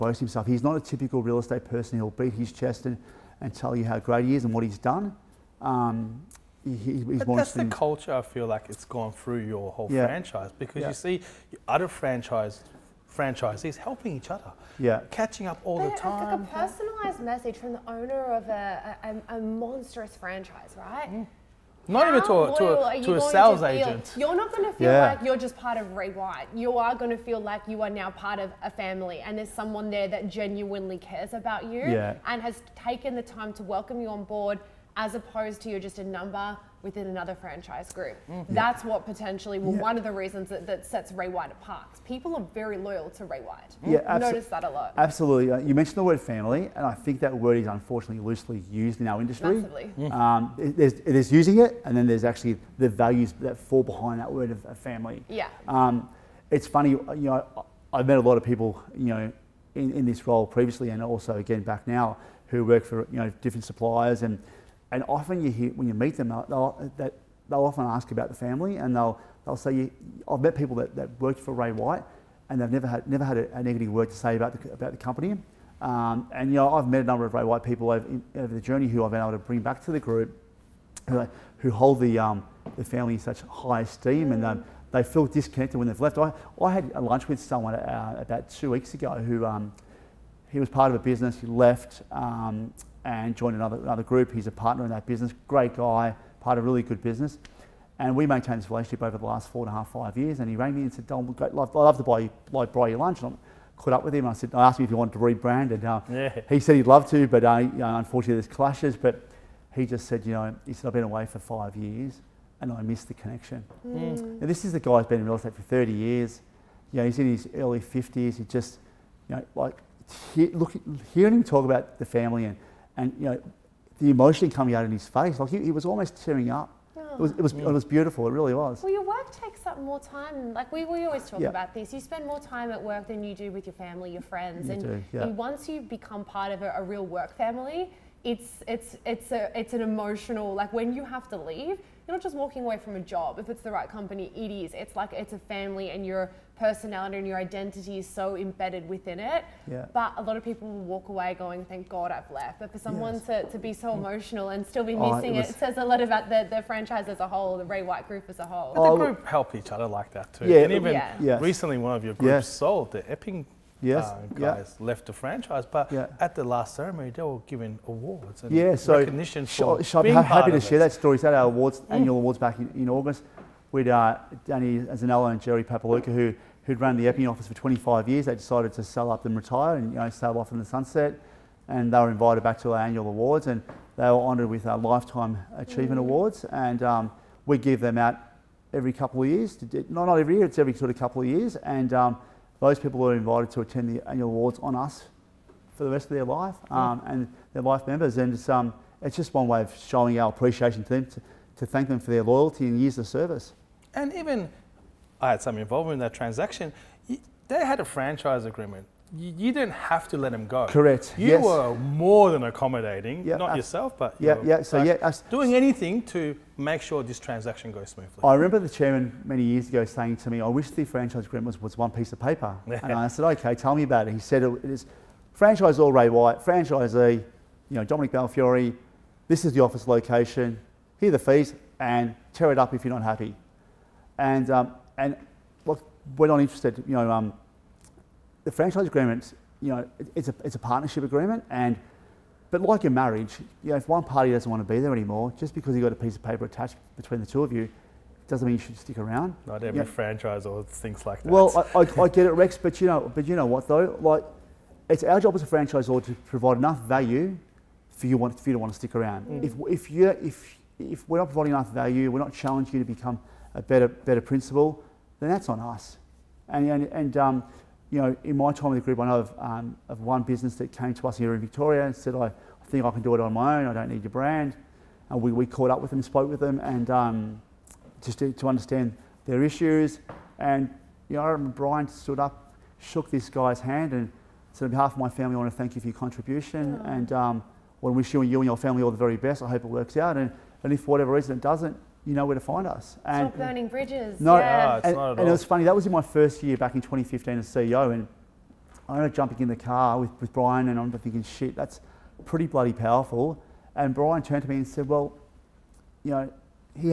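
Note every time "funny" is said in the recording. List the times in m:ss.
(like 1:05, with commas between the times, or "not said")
0:56, 4:55.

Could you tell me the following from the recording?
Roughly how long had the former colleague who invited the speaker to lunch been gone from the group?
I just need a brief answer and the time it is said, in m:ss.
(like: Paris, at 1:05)
5 years, at 1:50.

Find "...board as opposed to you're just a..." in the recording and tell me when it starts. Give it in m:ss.
0:34.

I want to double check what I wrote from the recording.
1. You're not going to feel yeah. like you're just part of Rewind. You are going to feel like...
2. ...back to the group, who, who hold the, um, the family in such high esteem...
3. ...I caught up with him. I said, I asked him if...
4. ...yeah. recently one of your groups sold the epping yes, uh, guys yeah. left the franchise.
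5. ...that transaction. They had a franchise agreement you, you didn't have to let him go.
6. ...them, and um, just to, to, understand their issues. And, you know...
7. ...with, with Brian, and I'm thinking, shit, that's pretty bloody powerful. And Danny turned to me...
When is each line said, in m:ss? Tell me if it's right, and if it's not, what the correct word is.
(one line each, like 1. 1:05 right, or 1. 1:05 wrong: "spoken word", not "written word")
1. 0:24 right
2. 1:19 right
3. 1:43 right
4. 2:40 right
5. 3:26 right
6. 4:36 right
7. 4:59 wrong: "Brian", not "Danny".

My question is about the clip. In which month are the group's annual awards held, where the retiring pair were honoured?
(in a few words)
August.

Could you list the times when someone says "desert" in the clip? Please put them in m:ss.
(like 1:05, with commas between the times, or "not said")
not said.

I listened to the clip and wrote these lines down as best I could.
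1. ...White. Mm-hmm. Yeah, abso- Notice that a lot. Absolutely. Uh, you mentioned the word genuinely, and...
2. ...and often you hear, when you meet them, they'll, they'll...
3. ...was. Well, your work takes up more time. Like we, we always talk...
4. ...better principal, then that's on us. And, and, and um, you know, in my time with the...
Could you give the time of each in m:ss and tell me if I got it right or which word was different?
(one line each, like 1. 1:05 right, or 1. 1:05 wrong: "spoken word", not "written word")
1. 0:43 wrong: "family", not "genuinely"
2. 1:04 right
3. 2:08 right
4. 4:23 right.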